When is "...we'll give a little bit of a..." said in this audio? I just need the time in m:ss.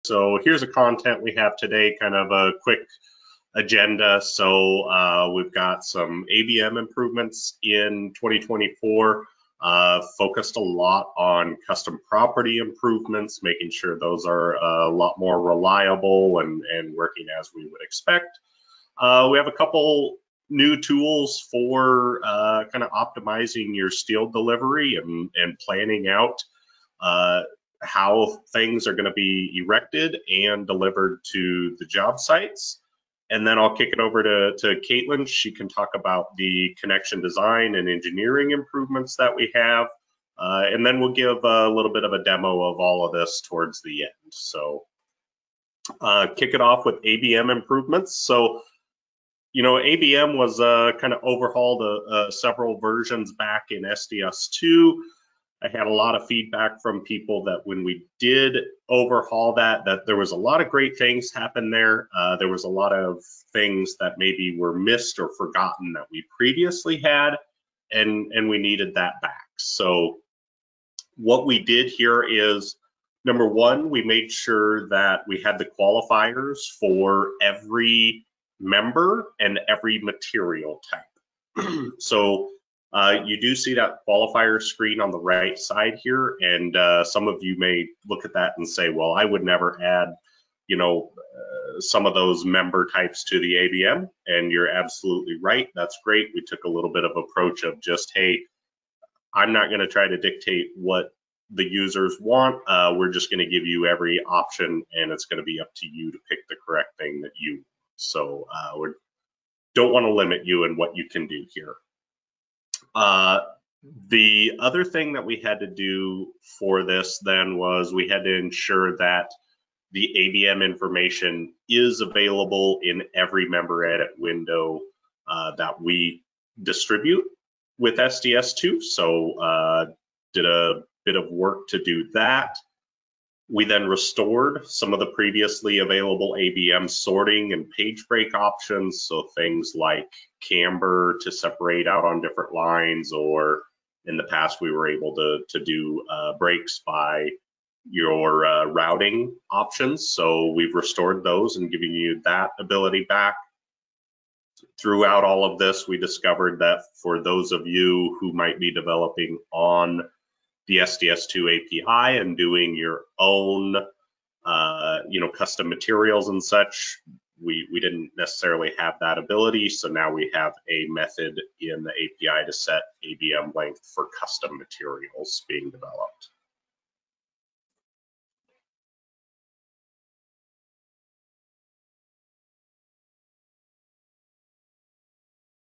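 0:40.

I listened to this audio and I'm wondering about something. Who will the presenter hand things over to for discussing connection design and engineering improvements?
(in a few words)
Caitlin.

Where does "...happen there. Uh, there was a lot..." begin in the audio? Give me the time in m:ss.
1:01.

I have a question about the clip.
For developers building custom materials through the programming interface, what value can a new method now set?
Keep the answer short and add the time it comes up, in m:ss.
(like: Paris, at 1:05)
ABM length, at 2:53.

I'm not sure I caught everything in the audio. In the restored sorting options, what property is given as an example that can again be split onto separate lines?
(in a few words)
Camber.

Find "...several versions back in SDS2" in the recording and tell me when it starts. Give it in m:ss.
0:52.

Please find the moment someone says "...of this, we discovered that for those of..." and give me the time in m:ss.
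2:35.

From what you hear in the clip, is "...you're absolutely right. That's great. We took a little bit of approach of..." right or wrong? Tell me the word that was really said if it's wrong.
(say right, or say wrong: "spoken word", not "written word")
right.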